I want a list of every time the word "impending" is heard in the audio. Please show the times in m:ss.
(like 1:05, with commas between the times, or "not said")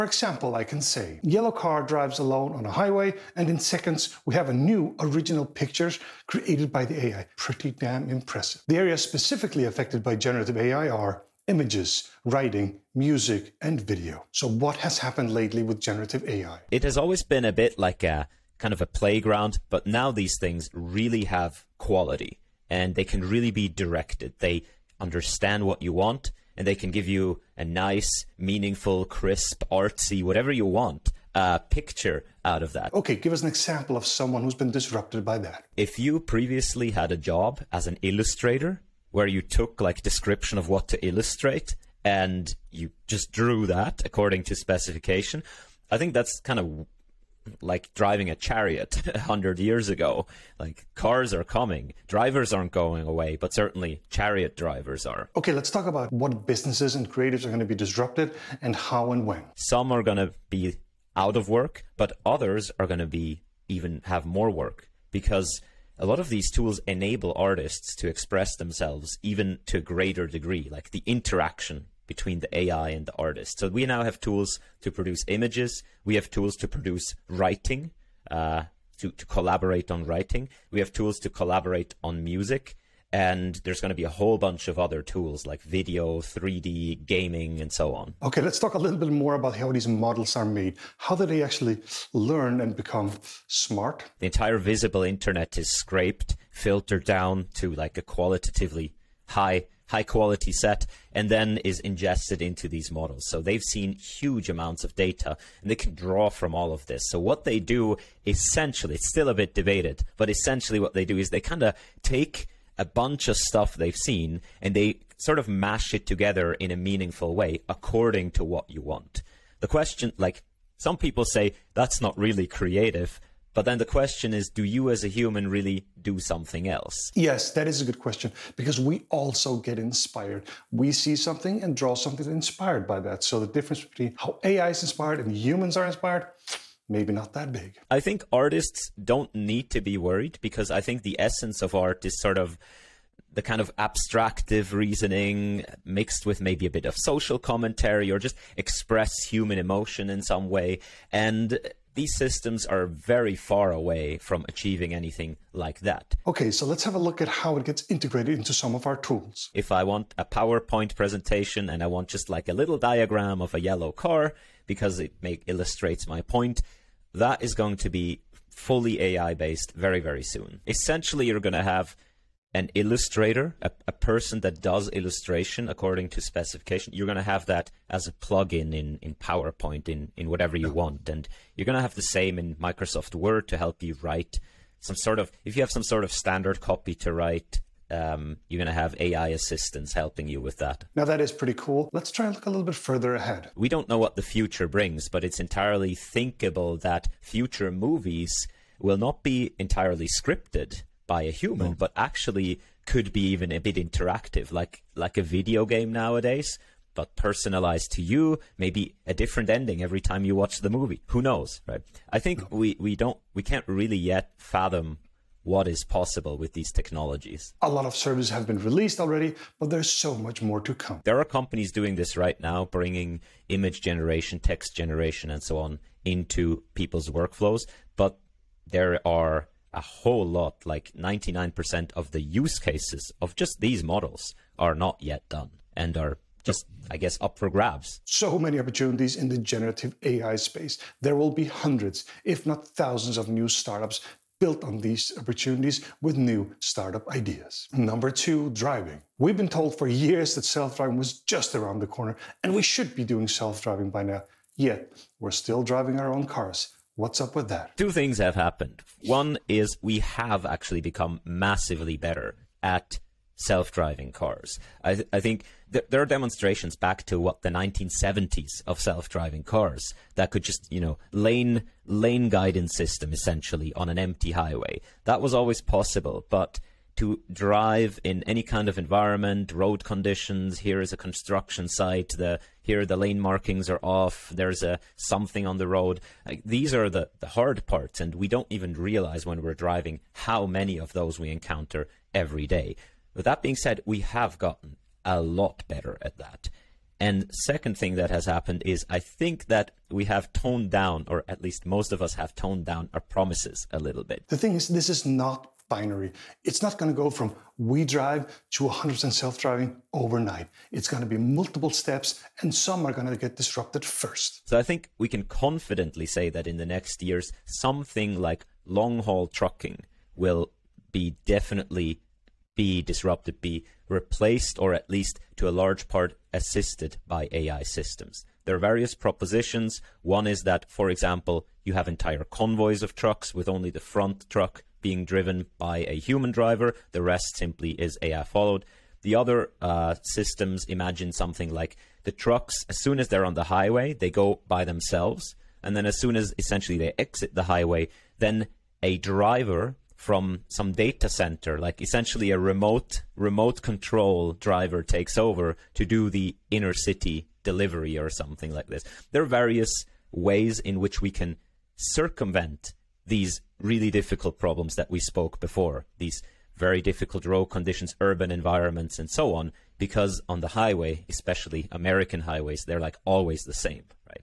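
not said.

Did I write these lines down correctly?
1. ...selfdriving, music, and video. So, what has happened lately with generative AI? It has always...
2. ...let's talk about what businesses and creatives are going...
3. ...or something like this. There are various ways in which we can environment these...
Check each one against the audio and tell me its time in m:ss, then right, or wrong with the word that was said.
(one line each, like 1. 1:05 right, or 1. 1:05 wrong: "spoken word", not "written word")
1. 0:12 wrong: "writing", not "selfdriving"
2. 0:55 right
3. 5:57 wrong: "circumvent", not "environment".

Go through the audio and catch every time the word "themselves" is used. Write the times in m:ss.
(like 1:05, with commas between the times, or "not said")
1:08, 5:44.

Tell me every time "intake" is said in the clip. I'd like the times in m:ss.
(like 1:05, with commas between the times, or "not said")
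not said.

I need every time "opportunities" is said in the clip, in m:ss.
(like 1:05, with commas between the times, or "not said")
3:58, 4:05.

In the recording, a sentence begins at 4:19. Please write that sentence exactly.
One is we have actually become massively better at self-driving cars.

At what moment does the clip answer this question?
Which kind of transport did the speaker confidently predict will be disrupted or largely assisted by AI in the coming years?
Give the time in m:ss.
5:18.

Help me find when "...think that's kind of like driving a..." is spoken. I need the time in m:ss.
0:45.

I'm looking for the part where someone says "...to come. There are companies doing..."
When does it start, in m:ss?
3:40.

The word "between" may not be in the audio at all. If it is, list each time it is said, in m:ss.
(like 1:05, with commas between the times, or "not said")
1:12, 2:13.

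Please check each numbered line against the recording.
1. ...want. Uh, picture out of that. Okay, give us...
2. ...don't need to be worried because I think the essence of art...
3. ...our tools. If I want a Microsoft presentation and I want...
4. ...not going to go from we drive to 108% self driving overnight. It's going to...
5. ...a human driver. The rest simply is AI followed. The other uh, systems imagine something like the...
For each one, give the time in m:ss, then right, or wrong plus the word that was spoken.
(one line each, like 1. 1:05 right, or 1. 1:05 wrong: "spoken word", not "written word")
1. 0:30 right
2. 2:19 right
3. 2:38 wrong: "PowerPoint", not "Microsoft"
4. 5:06 wrong: "100", not "108"
5. 5:35 right.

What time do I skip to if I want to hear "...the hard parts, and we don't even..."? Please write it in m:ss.
4:47.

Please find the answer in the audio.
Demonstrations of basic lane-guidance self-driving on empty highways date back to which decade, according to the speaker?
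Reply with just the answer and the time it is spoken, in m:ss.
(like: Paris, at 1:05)
1970s, at 4:27.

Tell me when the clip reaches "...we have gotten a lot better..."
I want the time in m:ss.
4:53.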